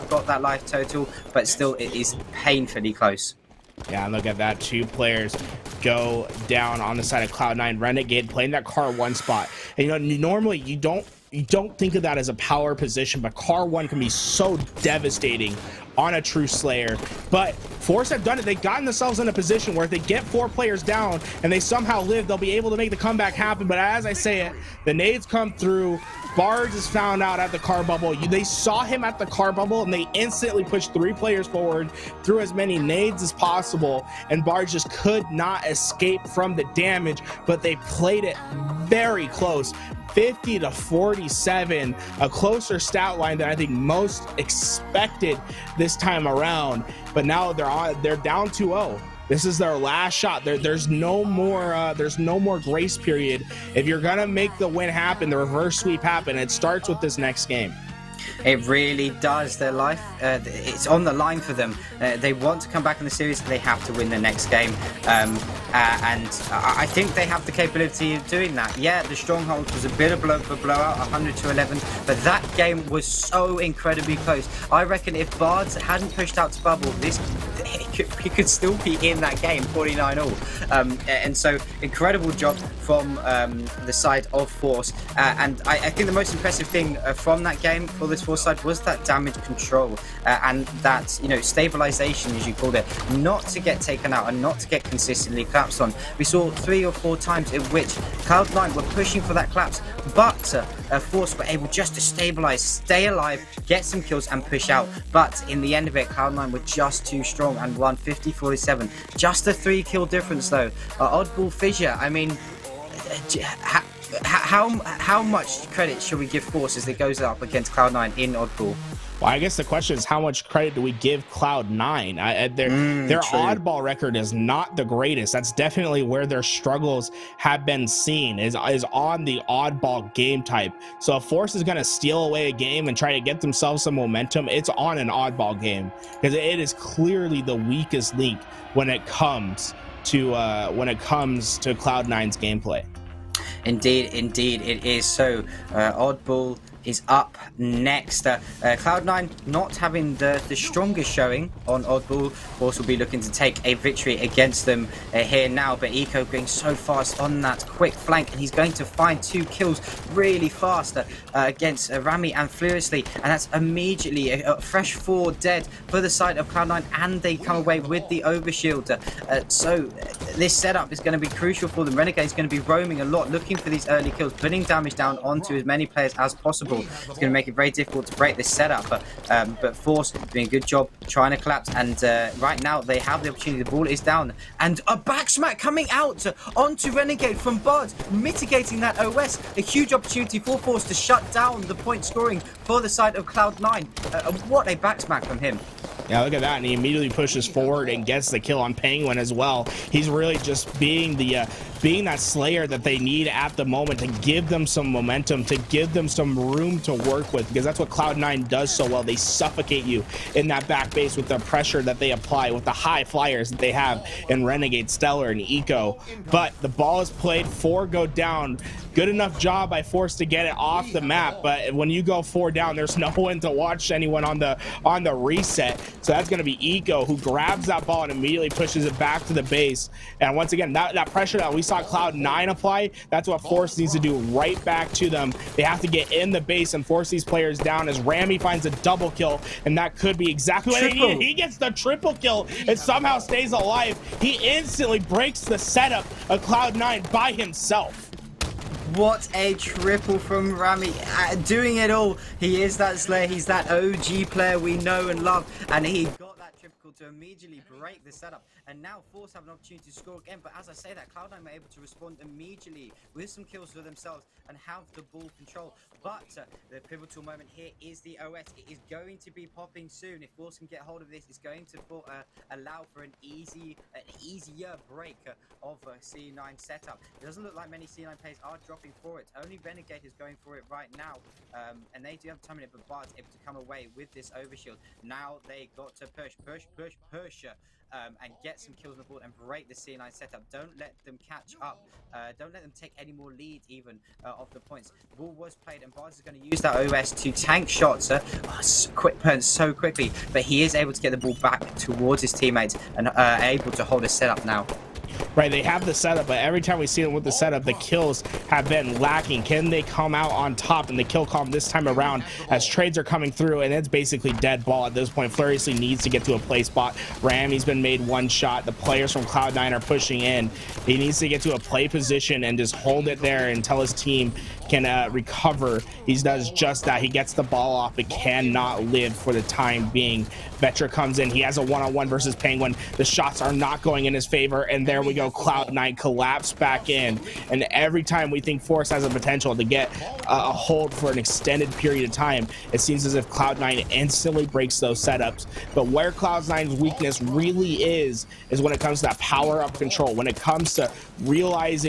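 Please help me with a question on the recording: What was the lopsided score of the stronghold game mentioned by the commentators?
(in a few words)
100 to 11.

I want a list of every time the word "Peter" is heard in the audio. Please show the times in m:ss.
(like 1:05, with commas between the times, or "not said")
not said.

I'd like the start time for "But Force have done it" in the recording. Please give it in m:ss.
0:17.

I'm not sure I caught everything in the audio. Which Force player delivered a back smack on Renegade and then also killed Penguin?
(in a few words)
Bud.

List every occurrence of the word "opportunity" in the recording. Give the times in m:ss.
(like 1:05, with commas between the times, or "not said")
3:03, 3:09, 4:19.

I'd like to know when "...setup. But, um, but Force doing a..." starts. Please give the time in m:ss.
2:58.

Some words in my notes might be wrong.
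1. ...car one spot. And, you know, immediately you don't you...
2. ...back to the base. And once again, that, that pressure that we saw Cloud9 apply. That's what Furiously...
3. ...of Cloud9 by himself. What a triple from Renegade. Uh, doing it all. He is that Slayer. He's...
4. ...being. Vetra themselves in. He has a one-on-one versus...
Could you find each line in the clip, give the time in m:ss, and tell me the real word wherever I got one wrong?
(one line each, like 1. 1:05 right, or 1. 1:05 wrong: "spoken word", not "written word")
1. 0:08 wrong: "normally", not "immediately"
2. 3:48 wrong: "Force", not "Furiously"
3. 4:06 wrong: "Rami", not "Renegade"
4. 5:29 wrong: "comes", not "themselves".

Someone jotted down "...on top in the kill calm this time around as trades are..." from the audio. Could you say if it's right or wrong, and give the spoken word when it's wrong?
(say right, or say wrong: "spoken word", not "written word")
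right.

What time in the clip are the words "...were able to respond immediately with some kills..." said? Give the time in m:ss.
4:21.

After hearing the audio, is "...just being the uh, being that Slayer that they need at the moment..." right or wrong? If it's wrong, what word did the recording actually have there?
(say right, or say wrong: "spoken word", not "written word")
right.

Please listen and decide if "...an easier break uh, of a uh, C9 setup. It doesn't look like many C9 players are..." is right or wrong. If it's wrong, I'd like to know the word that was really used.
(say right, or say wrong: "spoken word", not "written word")
right.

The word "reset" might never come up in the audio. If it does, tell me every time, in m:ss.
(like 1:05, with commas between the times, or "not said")
3:45.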